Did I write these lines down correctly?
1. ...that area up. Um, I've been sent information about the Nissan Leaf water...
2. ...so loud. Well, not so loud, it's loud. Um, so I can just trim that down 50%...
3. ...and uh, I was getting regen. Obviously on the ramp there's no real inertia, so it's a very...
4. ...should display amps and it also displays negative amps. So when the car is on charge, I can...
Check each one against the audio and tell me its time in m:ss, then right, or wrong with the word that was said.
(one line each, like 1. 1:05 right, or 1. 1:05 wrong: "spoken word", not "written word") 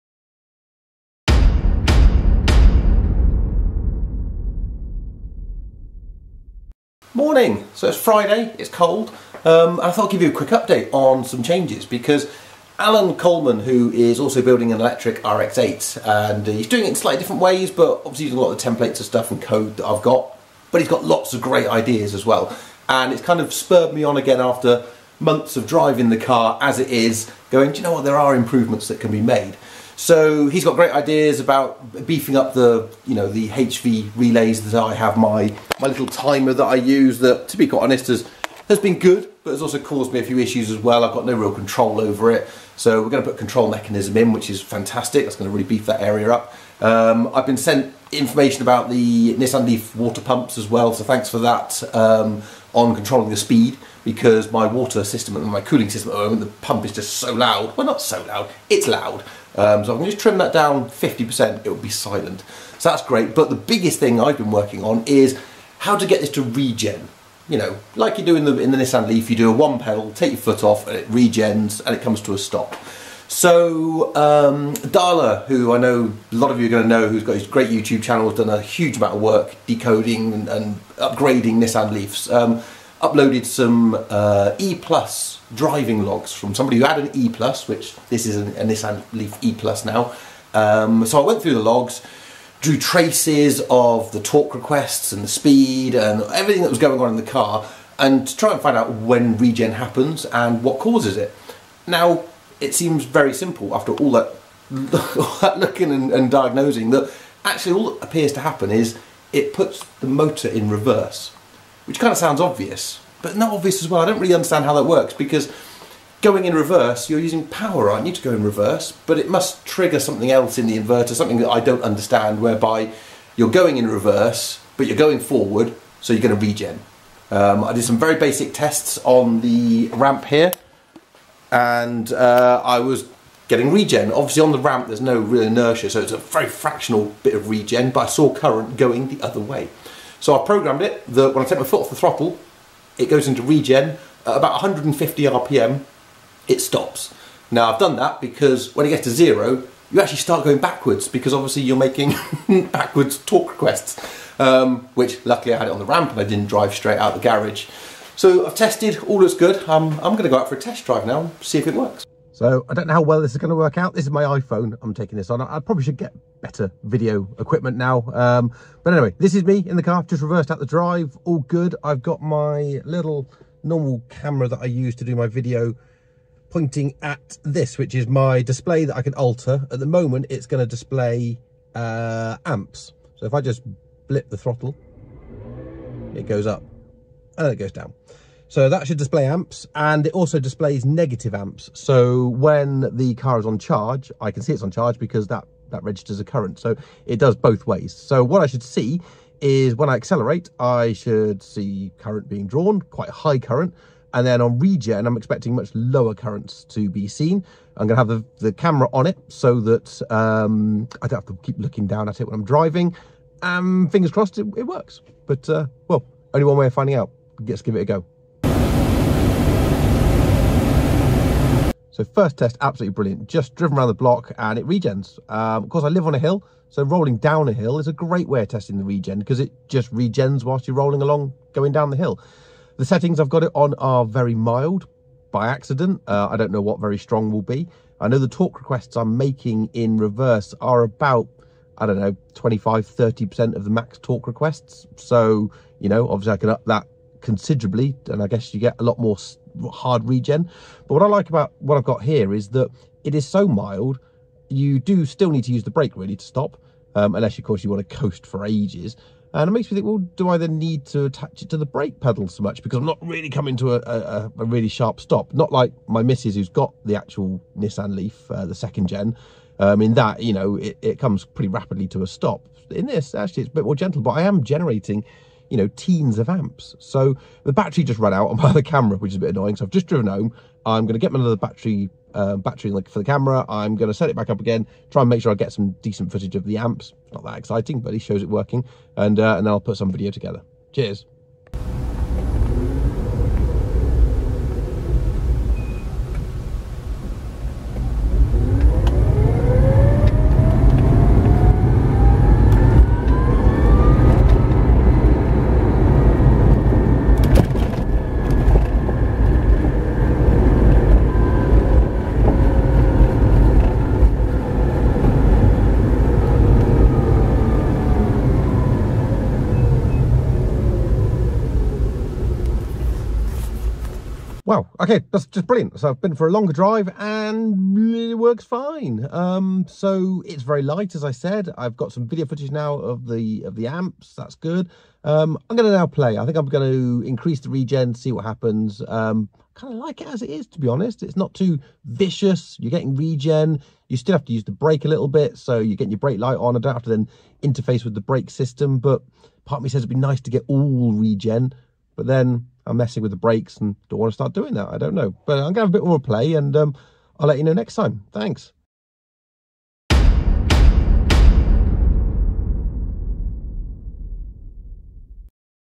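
1. 0:45 right
2. 0:57 right
3. 2:11 right
4. 3:08 right.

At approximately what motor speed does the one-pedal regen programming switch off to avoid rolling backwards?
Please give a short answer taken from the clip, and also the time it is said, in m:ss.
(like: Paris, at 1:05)
150 RPM, at 2:24.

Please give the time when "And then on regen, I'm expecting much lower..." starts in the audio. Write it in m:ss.
3:24.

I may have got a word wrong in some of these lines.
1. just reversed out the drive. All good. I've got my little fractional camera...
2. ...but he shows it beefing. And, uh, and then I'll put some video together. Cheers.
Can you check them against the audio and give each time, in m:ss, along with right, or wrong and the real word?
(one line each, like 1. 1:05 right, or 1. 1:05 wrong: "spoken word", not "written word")
1. 2:50 wrong: "normal", not "fractional"
2. 4:47 wrong: "working", not "beefing".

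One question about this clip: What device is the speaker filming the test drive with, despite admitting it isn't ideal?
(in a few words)
iPhone.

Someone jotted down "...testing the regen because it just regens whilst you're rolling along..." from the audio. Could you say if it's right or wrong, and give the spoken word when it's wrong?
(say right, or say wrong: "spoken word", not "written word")
right.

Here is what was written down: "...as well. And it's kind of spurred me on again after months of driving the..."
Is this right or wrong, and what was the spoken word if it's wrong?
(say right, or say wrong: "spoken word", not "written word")
right.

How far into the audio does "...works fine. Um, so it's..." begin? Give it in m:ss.
5:28.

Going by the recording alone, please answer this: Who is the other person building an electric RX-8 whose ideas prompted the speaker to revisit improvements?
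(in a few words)
Alan Coleman.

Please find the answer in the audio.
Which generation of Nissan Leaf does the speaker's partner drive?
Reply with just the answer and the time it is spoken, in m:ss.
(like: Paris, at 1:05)
second gen, at 4:28.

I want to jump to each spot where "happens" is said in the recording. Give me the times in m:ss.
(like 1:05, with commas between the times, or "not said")
1:39, 1:48, 5:38.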